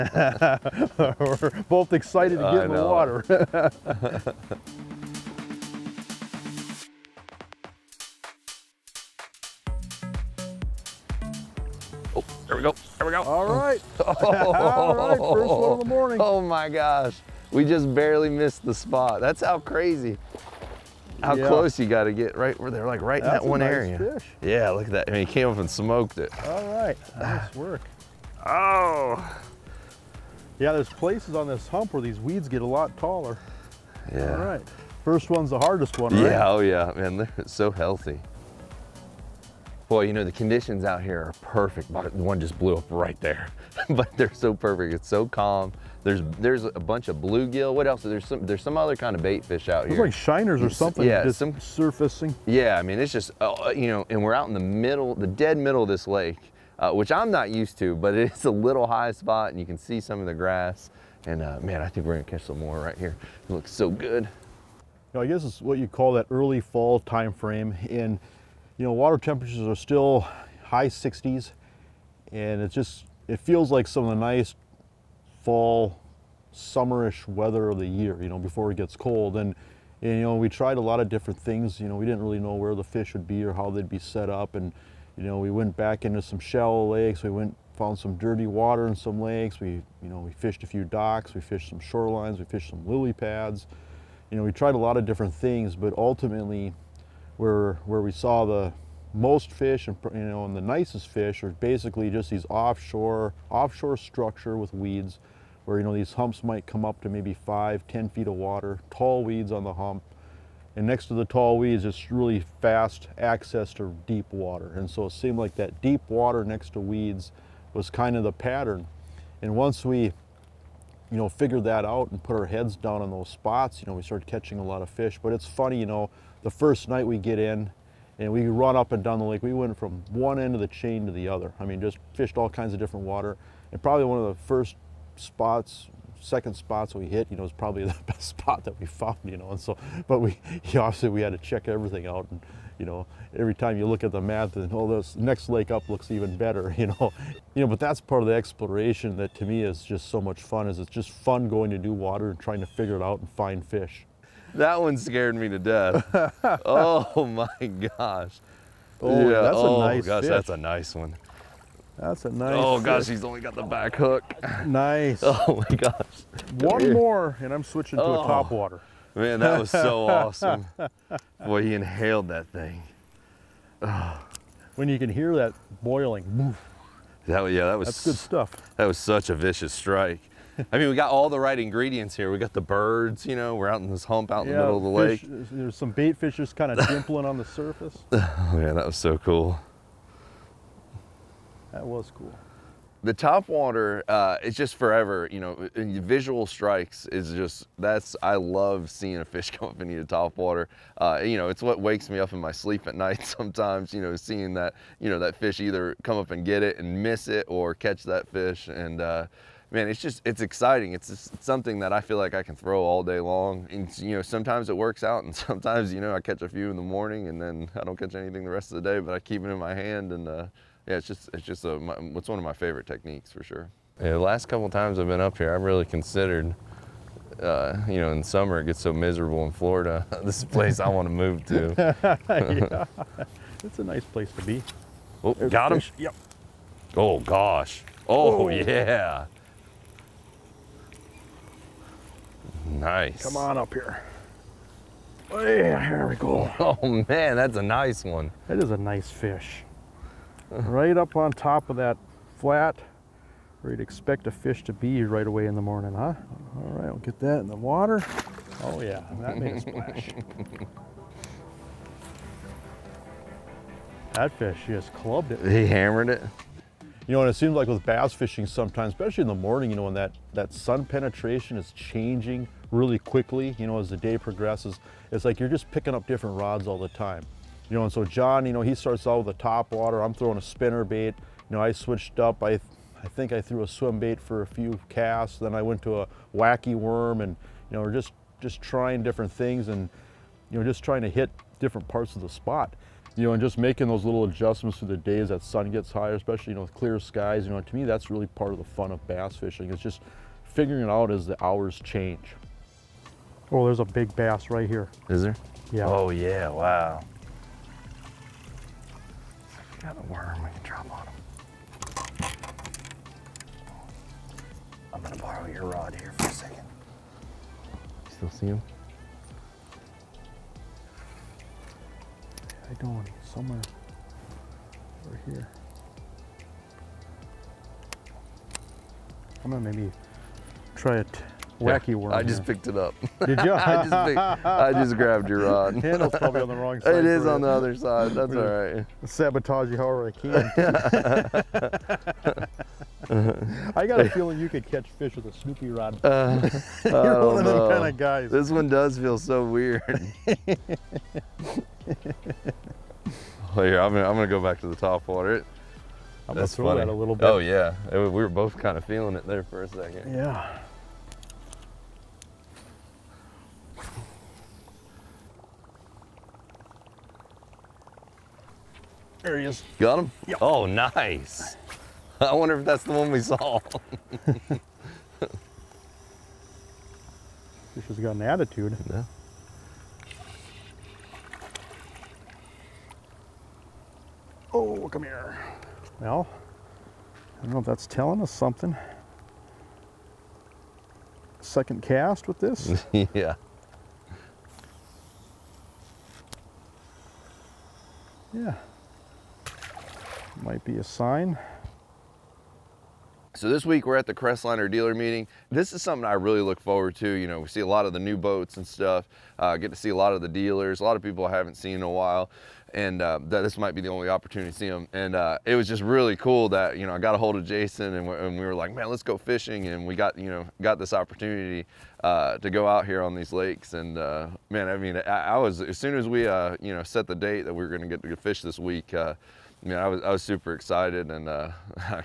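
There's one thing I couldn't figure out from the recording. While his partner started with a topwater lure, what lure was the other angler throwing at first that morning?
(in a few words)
spinner bait.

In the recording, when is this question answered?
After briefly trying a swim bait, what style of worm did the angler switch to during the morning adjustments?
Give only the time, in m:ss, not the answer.
4:46.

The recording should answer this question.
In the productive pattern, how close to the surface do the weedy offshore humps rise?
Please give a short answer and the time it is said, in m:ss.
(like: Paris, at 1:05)
5 to 10 feet, at 1:47.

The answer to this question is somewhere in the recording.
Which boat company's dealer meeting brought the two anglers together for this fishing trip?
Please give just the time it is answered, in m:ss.
6:44.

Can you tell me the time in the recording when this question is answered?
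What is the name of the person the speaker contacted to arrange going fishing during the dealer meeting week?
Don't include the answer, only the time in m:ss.
6:57.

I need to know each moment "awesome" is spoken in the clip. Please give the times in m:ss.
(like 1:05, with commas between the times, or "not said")
2:50.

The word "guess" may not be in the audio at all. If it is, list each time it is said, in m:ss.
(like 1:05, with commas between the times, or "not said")
1:05.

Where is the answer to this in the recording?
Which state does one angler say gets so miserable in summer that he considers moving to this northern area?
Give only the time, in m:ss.
3:49.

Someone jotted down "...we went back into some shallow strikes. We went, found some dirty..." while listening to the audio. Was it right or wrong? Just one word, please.
wrong.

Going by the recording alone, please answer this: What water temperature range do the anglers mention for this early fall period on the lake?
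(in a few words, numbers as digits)
high 60s.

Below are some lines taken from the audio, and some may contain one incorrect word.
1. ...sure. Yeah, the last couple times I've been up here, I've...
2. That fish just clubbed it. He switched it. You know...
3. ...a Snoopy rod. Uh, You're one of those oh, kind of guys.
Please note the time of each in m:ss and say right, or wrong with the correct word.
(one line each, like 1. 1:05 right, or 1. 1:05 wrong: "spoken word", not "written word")
1. 3:43 right
2. 4:24 wrong: "hammered", not "switched"
3. 5:45 right.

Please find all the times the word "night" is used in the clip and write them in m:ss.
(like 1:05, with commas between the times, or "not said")
2:06, 3:22.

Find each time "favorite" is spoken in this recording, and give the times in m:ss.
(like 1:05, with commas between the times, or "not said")
3:42.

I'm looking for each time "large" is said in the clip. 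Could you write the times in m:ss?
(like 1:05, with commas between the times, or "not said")
not said.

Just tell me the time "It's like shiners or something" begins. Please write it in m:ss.
0:49.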